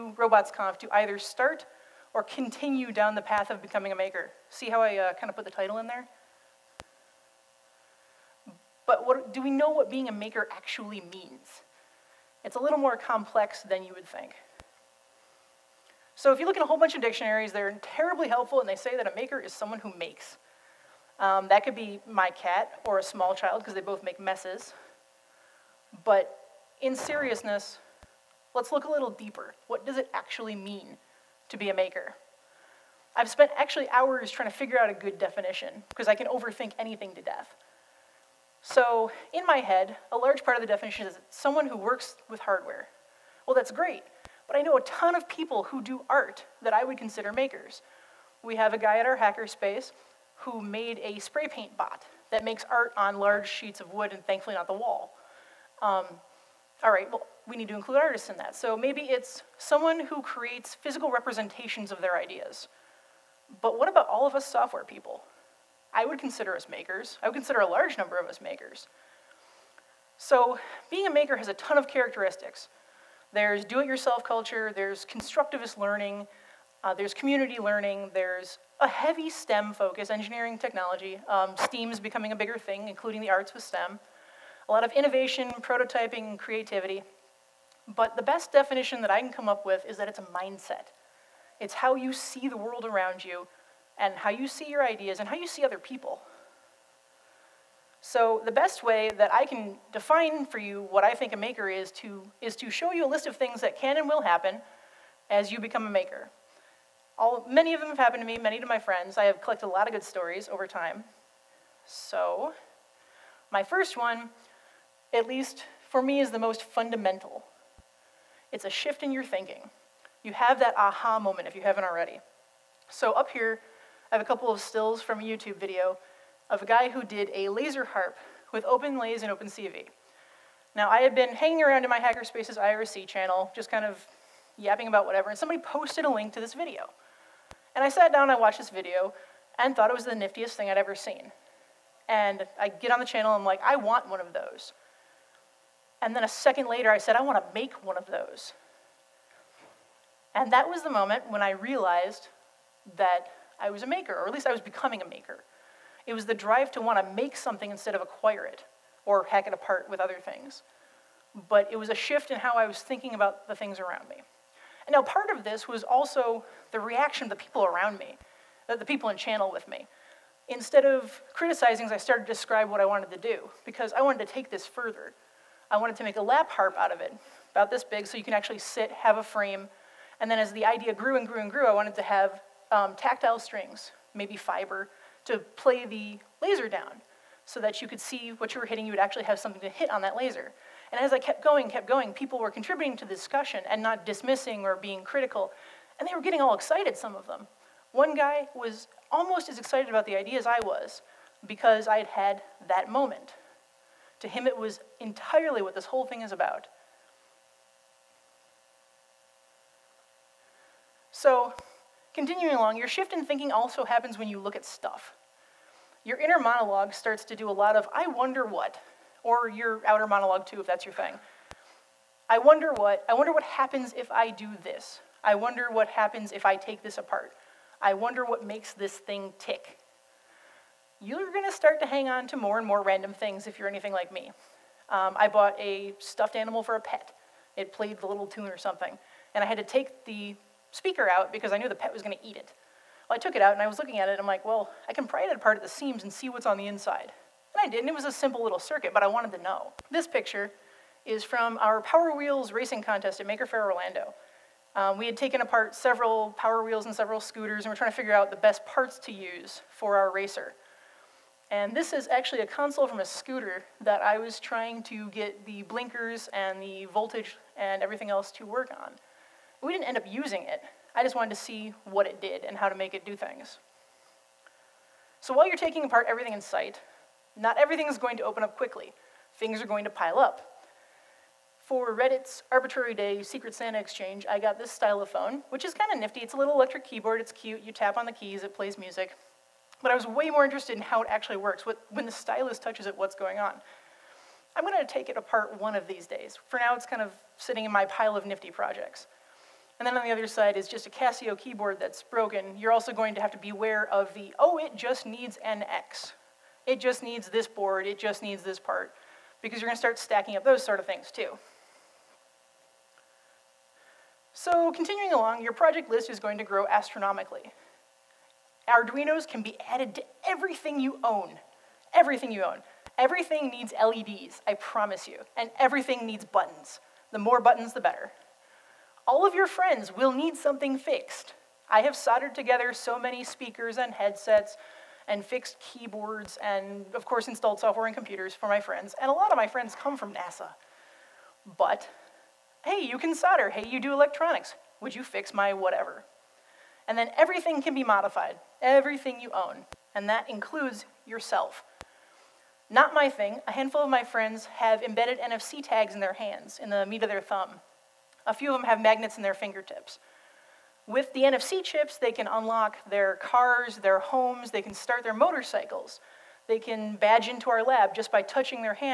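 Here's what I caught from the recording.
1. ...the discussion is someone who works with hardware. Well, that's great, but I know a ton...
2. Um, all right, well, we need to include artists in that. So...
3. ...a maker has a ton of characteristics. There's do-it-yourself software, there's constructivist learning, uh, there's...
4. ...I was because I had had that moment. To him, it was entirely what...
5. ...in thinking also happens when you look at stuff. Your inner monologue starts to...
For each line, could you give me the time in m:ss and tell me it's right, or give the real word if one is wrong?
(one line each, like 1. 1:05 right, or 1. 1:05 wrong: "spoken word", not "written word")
1. 0:40 wrong: "definition", not "discussion"
2. 0:55 right
3. 1:11 wrong: "culture", not "software"
4. 3:20 right
5. 3:33 right.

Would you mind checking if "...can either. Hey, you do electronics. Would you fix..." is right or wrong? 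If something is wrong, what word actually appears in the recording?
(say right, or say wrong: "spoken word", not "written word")
wrong: "solder", not "either".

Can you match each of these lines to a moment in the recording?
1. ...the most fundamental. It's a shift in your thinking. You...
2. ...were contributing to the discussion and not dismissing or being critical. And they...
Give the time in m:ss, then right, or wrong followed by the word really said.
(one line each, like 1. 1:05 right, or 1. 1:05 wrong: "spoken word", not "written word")
1. 1:56 right
2. 3:12 right.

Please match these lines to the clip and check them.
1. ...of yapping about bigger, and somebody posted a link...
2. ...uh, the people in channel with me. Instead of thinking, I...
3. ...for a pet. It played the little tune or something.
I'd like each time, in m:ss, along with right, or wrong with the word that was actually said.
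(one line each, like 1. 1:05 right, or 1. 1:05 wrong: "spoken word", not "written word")
1. 2:13 wrong: "whatever", not "bigger"
2. 2:48 wrong: "criticizing", not "thinking"
3. 3:56 right.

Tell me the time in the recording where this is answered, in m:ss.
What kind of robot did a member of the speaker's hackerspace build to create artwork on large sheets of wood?
0:51.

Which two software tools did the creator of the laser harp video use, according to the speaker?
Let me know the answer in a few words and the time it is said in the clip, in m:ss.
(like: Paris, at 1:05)
OpenLase and OpenCV, at 2:08.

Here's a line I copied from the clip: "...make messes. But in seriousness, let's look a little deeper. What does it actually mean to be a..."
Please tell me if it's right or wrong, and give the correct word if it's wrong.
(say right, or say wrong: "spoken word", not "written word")
right.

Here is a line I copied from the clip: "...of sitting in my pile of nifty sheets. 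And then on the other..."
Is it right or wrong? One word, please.
wrong.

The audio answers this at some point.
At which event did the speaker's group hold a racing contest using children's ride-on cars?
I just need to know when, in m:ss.
4:13.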